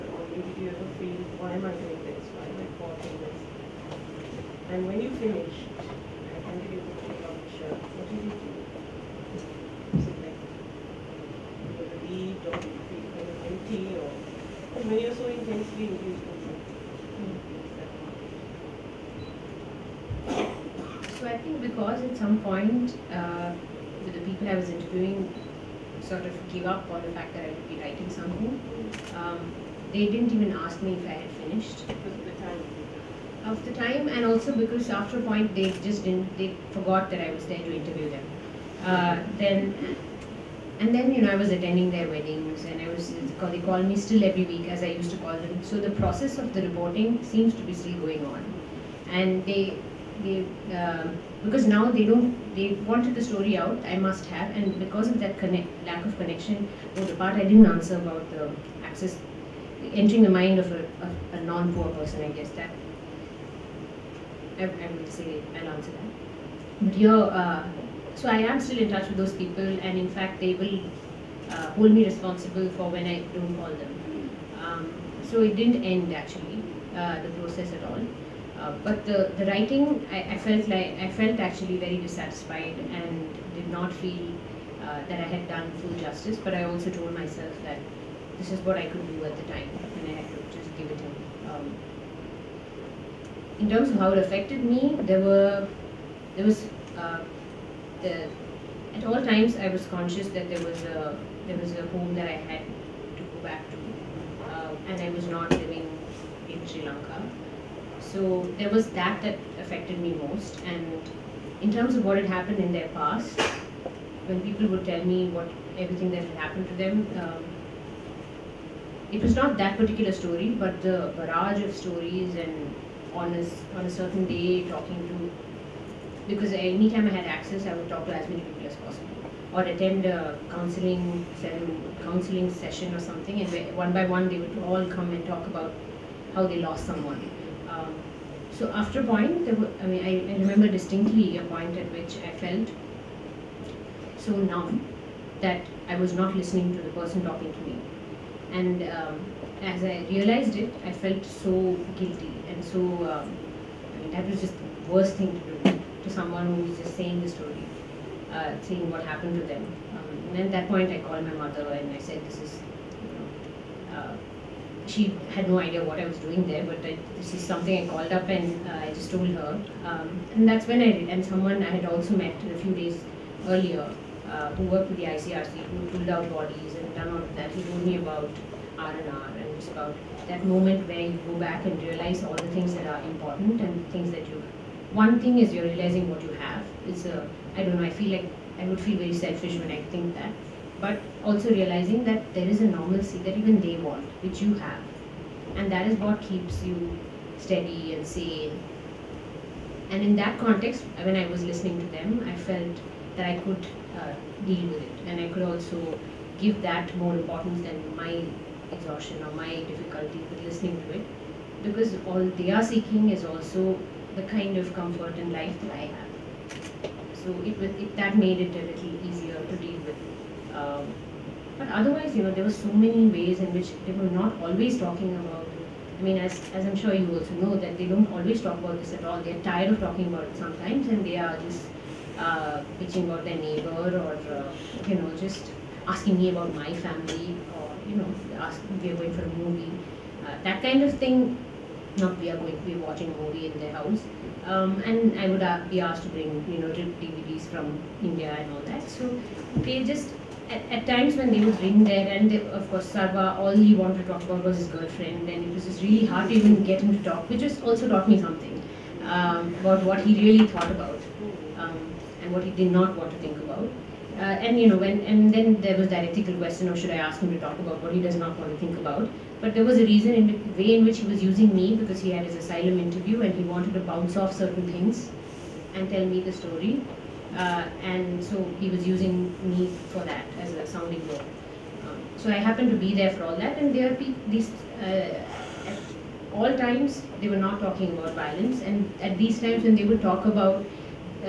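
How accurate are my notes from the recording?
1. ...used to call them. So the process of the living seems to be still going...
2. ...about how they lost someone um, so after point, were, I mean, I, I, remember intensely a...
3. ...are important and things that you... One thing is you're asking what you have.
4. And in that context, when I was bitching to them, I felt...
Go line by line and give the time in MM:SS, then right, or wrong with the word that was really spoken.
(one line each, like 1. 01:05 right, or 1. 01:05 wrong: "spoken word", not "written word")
1. 00:44 wrong: "reporting", not "living"
2. 02:15 wrong: "distinctly", not "intensely"
3. 03:02 wrong: "realizing", not "asking"
4. 03:19 wrong: "listening", not "bitching".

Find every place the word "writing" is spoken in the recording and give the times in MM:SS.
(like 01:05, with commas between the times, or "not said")
00:27, 01:19.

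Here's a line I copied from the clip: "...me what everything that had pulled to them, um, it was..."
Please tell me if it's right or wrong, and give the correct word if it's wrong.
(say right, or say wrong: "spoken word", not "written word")
wrong: "happened", not "pulled".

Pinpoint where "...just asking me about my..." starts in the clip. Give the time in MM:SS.
03:55.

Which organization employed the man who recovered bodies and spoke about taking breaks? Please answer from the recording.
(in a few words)
ICRC.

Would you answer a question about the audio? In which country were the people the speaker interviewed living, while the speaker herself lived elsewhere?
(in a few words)
Sri Lanka.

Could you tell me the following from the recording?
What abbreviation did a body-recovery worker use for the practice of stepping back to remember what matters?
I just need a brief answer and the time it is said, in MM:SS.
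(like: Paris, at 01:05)
R&R, at 02:58.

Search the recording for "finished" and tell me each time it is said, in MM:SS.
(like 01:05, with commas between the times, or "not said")
00:05, 00:31.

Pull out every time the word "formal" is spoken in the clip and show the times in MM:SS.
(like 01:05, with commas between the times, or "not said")
not said.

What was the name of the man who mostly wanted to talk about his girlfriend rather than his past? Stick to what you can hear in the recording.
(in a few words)
Sarva.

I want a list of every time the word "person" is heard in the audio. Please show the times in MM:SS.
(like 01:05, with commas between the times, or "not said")
01:01, 02:26.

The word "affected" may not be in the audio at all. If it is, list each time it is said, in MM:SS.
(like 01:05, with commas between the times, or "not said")
01:34, 01:49.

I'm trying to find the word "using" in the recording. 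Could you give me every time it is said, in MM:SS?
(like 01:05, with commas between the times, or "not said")
04:31, 04:38.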